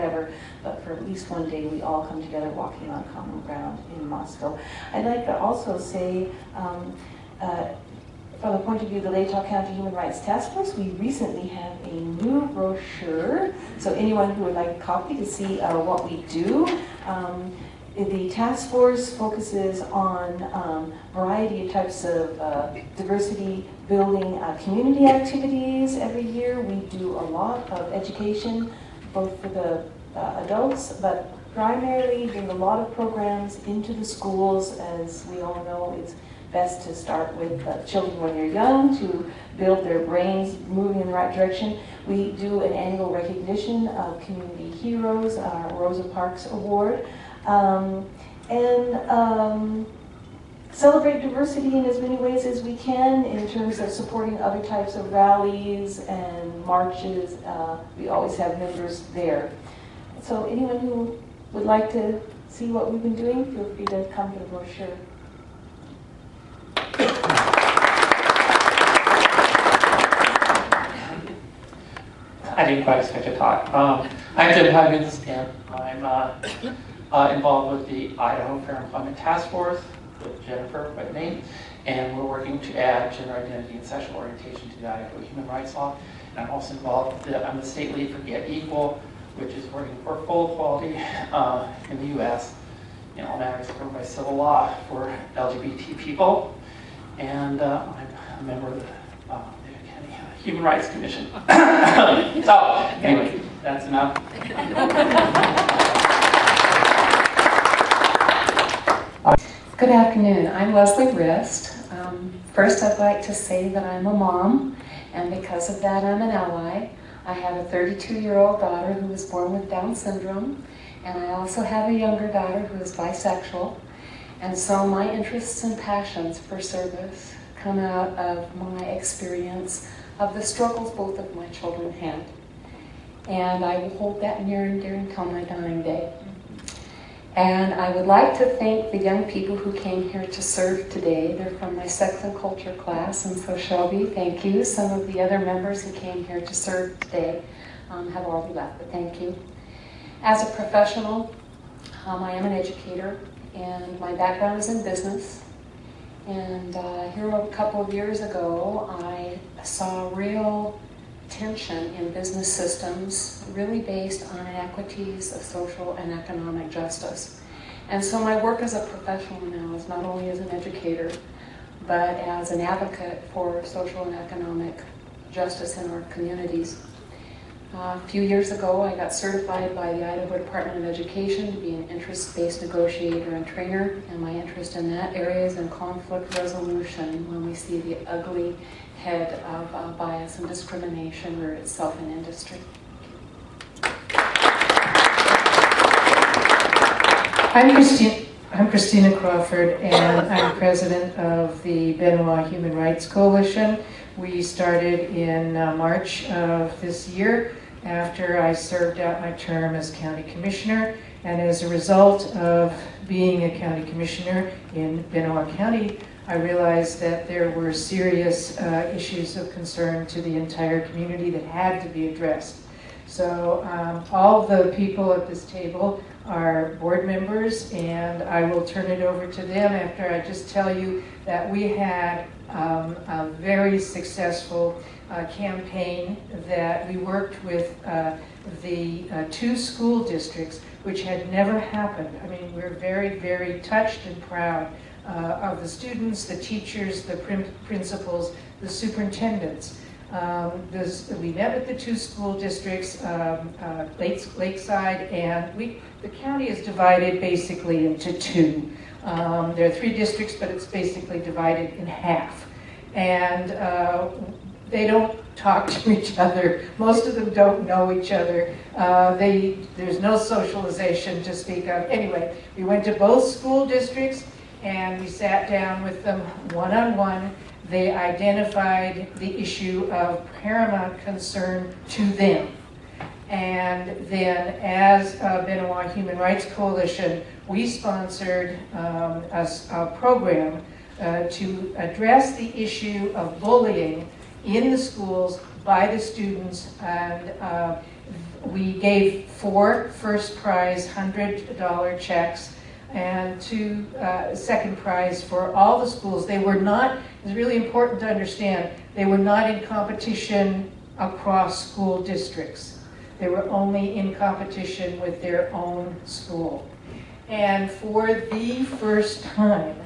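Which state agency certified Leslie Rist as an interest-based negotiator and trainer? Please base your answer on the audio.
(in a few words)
Idaho Department of Education.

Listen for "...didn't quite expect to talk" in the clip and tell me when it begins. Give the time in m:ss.
1:12.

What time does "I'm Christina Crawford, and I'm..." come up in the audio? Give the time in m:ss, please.
3:18.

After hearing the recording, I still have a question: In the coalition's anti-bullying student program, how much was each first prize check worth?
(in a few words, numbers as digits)
$100.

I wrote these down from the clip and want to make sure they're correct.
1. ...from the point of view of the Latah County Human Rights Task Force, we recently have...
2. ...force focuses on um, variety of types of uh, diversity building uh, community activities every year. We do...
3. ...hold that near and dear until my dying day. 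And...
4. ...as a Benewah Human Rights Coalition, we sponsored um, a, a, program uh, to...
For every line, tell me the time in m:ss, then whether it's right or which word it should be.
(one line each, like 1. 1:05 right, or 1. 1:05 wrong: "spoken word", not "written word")
1. 0:08 right
2. 0:18 right
3. 2:13 right
4. 4:44 right.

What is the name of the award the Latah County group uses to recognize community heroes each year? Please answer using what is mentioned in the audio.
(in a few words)
Rosa Parks Award.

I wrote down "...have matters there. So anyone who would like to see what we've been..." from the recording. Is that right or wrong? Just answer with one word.
wrong.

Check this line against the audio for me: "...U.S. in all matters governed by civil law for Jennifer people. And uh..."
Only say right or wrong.
wrong.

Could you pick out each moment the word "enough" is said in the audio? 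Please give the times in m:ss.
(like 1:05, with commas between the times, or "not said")
1:43.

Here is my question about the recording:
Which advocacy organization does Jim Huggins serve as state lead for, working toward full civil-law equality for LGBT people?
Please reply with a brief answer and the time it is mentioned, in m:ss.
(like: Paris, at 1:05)
Get Equal, at 1:28.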